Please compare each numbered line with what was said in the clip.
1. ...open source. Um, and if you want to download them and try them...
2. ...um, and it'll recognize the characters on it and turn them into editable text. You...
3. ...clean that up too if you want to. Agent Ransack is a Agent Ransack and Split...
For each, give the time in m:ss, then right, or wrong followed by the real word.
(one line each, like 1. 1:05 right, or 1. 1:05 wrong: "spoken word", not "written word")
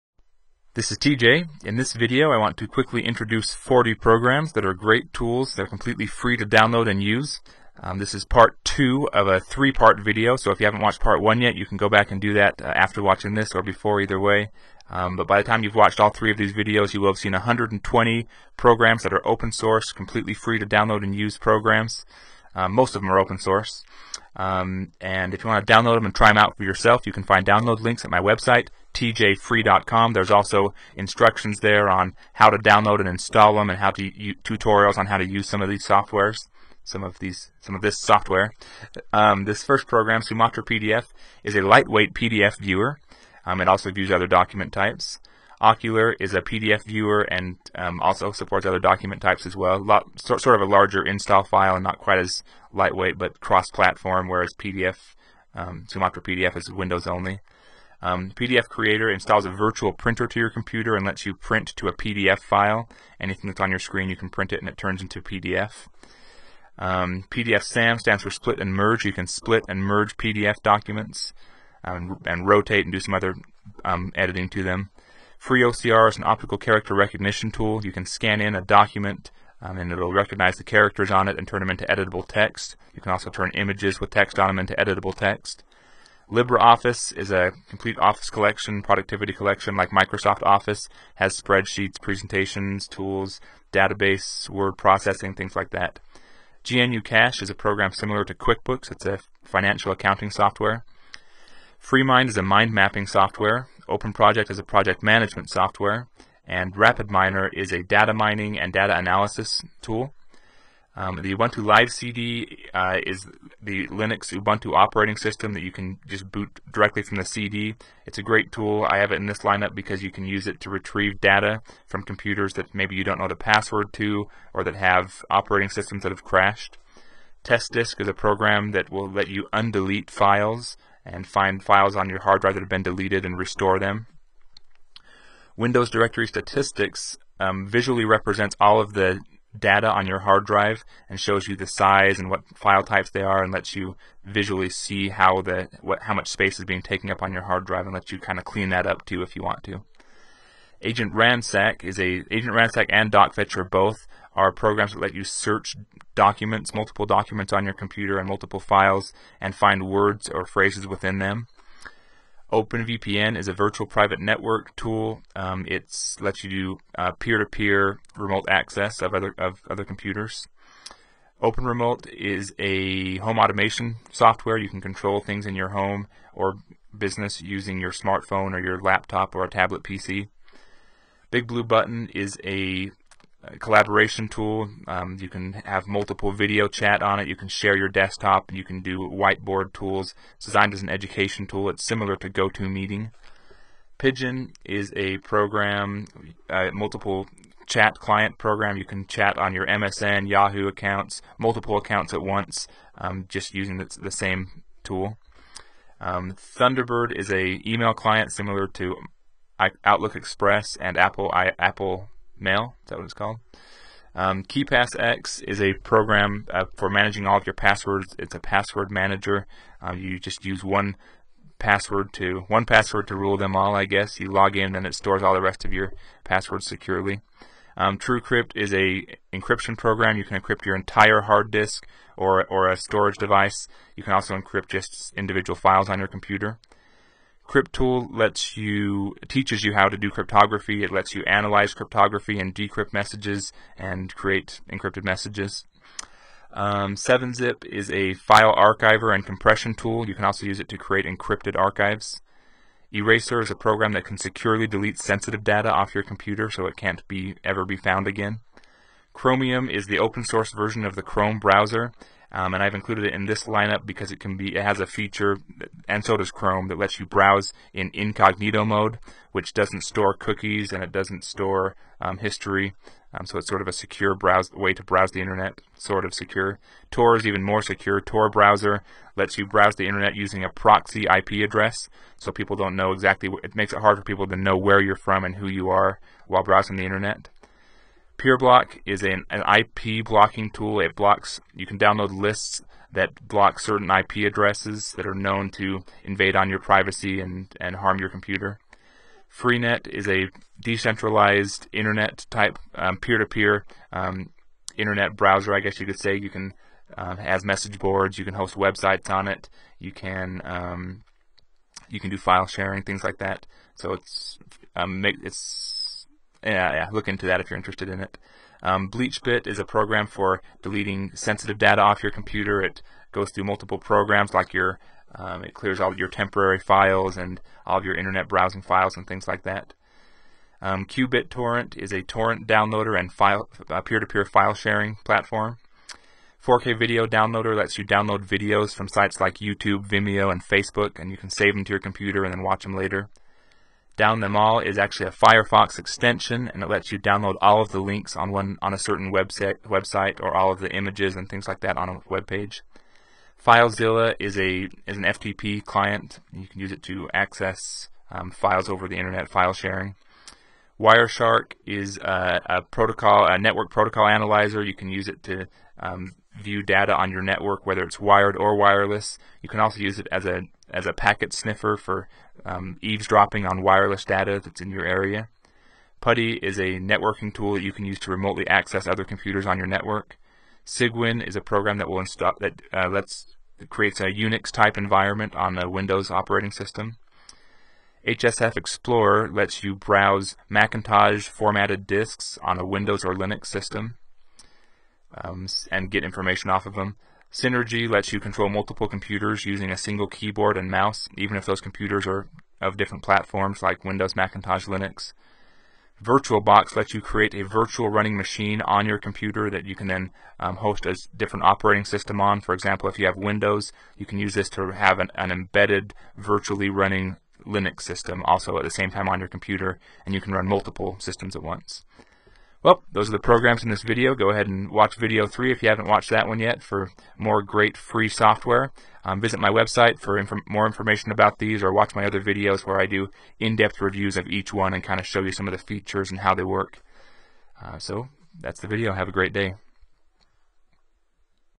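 1. 0:23 right
2. 1:19 right
3. 2:28 wrong: "DocFetch", not "Split".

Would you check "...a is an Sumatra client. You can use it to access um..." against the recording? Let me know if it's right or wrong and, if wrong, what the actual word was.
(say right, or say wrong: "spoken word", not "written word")
wrong: "FTP", not "Sumatra".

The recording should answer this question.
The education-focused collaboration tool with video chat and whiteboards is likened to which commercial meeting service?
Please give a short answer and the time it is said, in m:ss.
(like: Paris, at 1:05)
GoToMeeting, at 3:12.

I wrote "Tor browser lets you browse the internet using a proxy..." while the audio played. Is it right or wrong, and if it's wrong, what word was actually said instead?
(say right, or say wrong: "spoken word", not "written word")
right.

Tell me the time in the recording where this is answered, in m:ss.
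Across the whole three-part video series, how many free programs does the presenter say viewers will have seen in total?
0:17.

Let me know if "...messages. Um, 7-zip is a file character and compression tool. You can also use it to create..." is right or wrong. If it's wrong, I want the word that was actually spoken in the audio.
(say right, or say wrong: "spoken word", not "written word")
wrong: "archiver", not "character".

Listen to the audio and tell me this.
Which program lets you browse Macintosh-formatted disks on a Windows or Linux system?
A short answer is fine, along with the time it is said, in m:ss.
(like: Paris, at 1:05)
HSF Explorer, at 6:28.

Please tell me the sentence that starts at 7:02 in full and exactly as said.
Well, those are the programs in this video.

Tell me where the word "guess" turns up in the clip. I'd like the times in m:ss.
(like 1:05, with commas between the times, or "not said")
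3:43, 5:05.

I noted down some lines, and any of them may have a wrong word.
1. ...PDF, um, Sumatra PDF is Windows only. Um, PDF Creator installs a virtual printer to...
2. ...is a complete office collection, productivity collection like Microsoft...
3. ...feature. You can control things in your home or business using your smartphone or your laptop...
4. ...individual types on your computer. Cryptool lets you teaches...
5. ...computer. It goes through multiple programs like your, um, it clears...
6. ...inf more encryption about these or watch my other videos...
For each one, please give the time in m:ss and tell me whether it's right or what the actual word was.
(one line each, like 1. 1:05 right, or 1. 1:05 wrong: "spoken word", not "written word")
1. 0:54 right
2. 1:27 right
3. 2:54 wrong: "software", not "feature"
4. 3:55 wrong: "files", not "types"
5. 5:22 right
6. 7:10 wrong: "information", not "encryption".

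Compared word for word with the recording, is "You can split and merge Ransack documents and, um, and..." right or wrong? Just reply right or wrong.
wrong.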